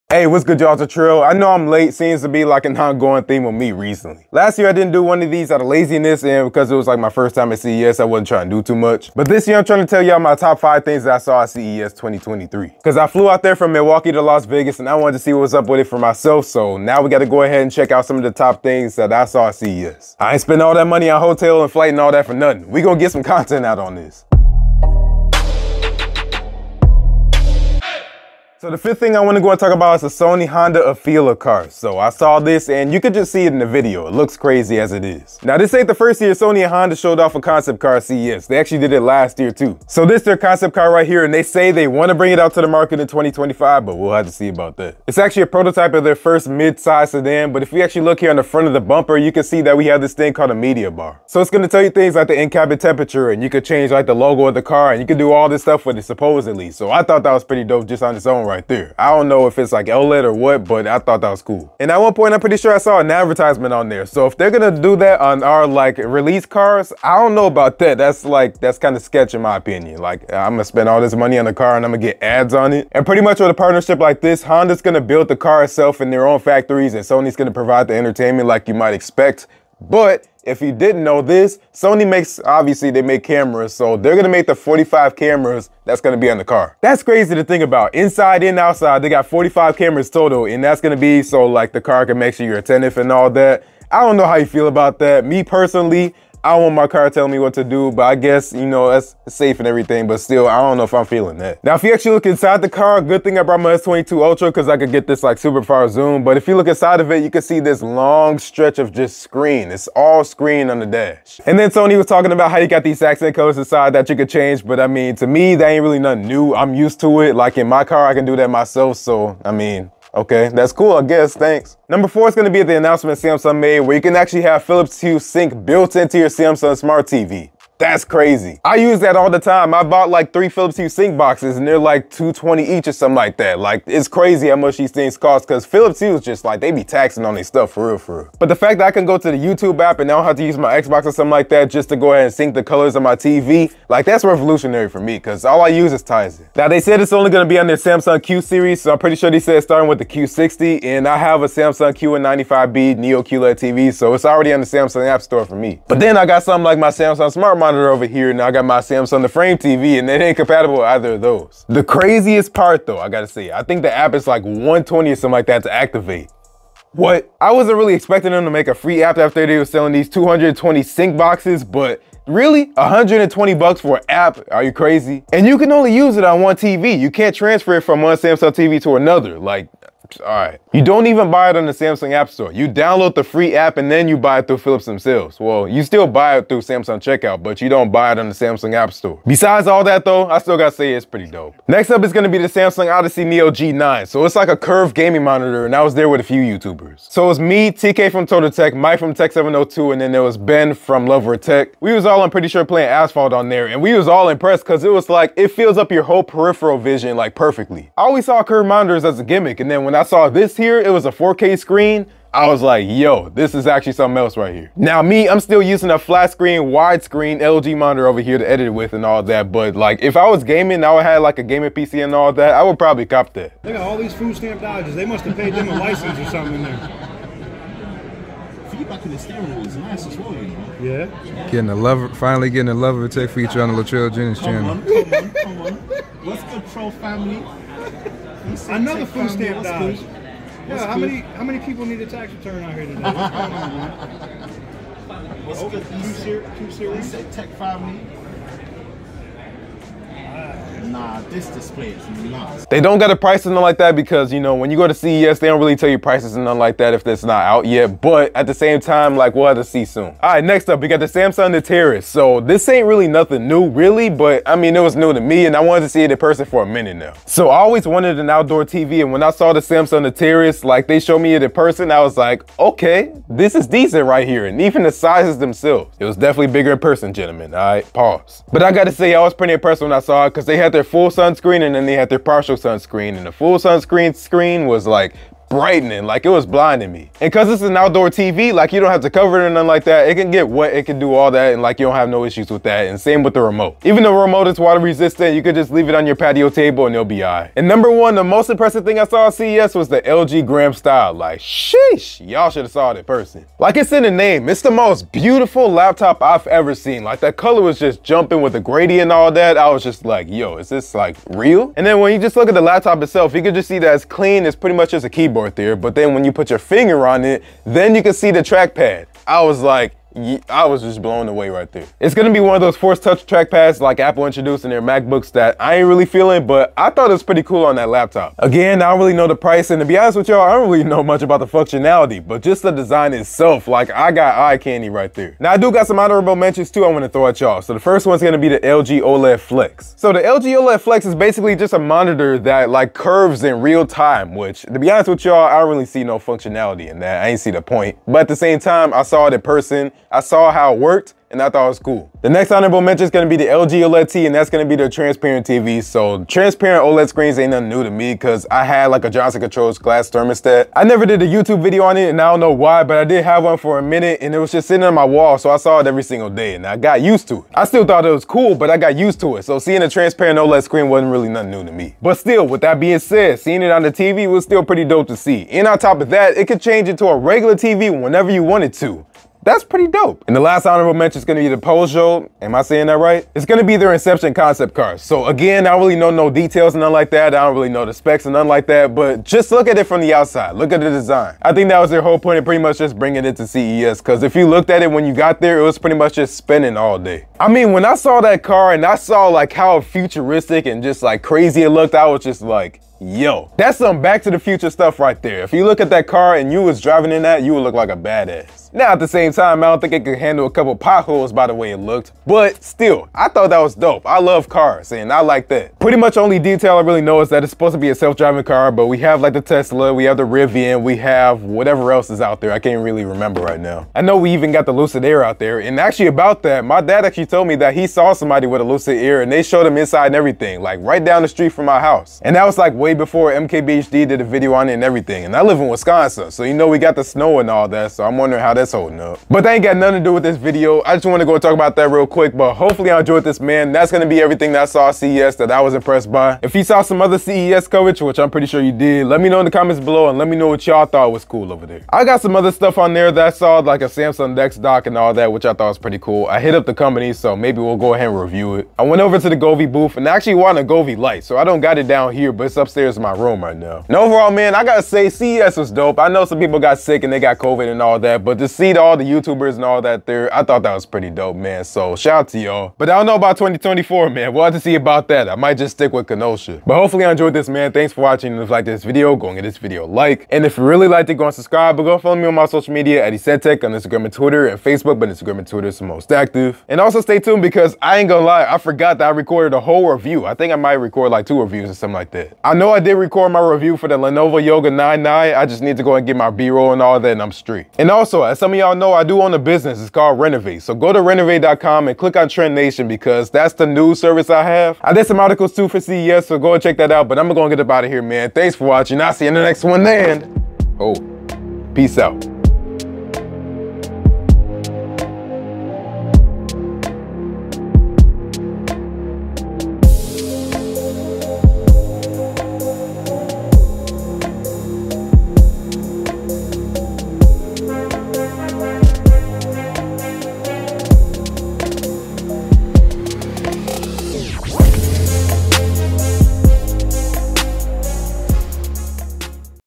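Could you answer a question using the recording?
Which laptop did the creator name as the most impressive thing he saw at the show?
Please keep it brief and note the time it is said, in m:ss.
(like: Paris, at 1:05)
LG Gram Style, at 5:00.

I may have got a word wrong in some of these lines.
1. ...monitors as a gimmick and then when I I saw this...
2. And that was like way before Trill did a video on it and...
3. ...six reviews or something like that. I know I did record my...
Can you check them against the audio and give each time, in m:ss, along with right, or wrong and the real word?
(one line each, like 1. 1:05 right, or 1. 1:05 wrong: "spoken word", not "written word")
1. 3:28 right
2. 7:12 wrong: "MKBHD", not "Trill"
3. 8:11 wrong: "two", not "six".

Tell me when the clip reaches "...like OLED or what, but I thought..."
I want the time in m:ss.
0:59.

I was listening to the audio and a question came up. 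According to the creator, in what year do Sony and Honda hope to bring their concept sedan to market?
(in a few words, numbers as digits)
2025.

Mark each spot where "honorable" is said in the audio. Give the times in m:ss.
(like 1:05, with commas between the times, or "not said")
5:35, 5:52, 6:20.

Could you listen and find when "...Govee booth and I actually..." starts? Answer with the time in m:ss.
7:39.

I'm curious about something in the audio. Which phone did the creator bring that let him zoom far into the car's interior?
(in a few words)
S22 Ultra.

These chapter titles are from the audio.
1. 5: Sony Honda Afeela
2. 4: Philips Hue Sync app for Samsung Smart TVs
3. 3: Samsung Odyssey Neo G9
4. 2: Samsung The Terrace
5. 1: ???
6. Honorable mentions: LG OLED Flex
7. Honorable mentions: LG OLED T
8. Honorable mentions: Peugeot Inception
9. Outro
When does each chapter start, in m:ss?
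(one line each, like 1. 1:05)
1. 0:28
2. 2:02
3. 3:11
4. 4:20
5. 4:57
6. 5:35
7. 5:52
8. 6:20
9. 7:19.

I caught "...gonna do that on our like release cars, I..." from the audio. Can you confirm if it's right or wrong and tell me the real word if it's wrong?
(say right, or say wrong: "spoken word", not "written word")
right.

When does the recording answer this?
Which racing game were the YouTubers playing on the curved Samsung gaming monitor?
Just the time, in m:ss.
3:22.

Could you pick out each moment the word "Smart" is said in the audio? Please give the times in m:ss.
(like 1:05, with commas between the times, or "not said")
2:06, 2:37.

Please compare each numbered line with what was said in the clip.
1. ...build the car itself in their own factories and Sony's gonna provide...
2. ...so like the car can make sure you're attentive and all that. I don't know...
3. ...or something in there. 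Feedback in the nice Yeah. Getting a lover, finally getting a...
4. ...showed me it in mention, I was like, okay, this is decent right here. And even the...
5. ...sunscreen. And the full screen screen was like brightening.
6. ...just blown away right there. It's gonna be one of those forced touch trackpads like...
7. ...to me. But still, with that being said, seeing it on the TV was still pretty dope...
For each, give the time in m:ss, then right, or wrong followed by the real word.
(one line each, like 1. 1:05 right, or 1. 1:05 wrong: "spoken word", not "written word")
1. 1:15 right
2. 1:31 right
3. 3:46 right
4. 4:30 wrong: "person", not "mention"
5. 4:42 wrong: "sunscreen", not "screen"
6. 5:20 right
7. 6:11 right.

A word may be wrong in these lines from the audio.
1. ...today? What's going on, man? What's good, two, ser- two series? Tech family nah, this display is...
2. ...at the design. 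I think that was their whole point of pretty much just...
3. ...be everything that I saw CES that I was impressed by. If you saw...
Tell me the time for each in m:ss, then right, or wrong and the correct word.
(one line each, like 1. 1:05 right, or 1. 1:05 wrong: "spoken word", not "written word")
1. 4:02 right
2. 6:30 right
3. 7:24 right.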